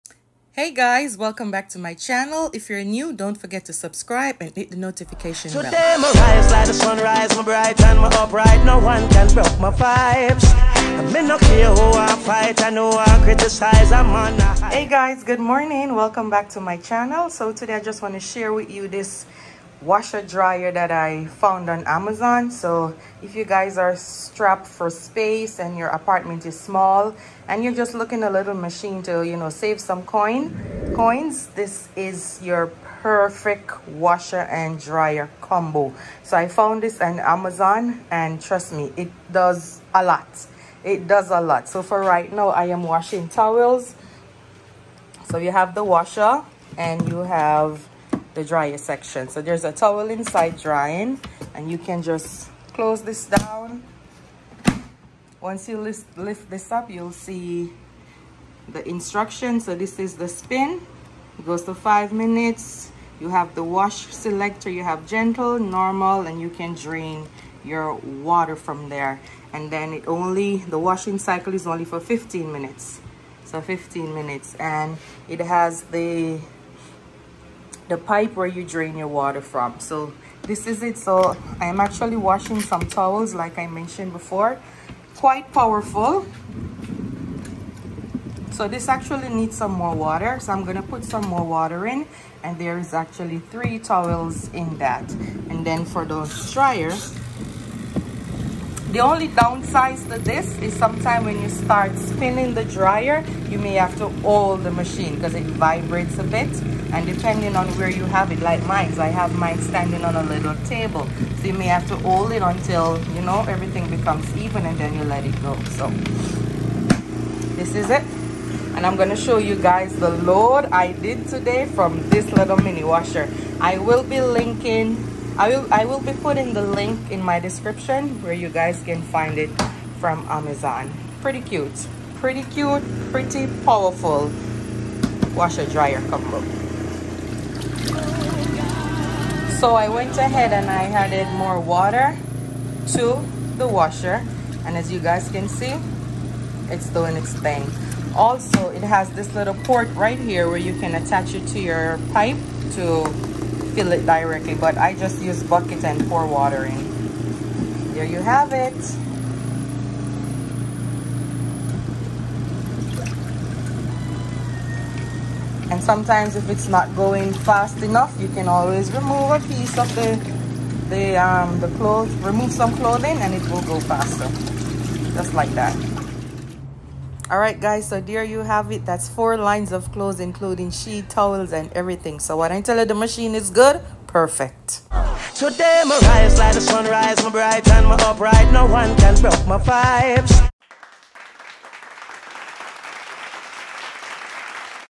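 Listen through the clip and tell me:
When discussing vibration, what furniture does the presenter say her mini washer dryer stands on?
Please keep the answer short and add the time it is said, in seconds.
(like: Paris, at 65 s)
A little table, at 110 s.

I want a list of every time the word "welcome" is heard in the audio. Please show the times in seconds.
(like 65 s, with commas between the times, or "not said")
1 s, 15 s.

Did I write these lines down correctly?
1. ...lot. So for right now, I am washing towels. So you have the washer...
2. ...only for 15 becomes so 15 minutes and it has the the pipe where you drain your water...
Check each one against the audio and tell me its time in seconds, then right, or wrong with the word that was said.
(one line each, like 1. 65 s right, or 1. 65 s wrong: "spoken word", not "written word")
1. 41 s right
2. 71 s wrong: "minutes", not "becomes".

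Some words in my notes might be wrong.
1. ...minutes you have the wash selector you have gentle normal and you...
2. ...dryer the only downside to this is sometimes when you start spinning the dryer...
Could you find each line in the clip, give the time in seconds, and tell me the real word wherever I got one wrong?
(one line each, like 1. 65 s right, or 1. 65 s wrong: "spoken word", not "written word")
1. 62 s right
2. 96 s right.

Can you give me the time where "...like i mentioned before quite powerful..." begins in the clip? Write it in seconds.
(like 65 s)
83 s.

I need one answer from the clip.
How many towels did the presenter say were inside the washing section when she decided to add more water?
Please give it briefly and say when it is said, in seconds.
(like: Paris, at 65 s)
3, at 93 s.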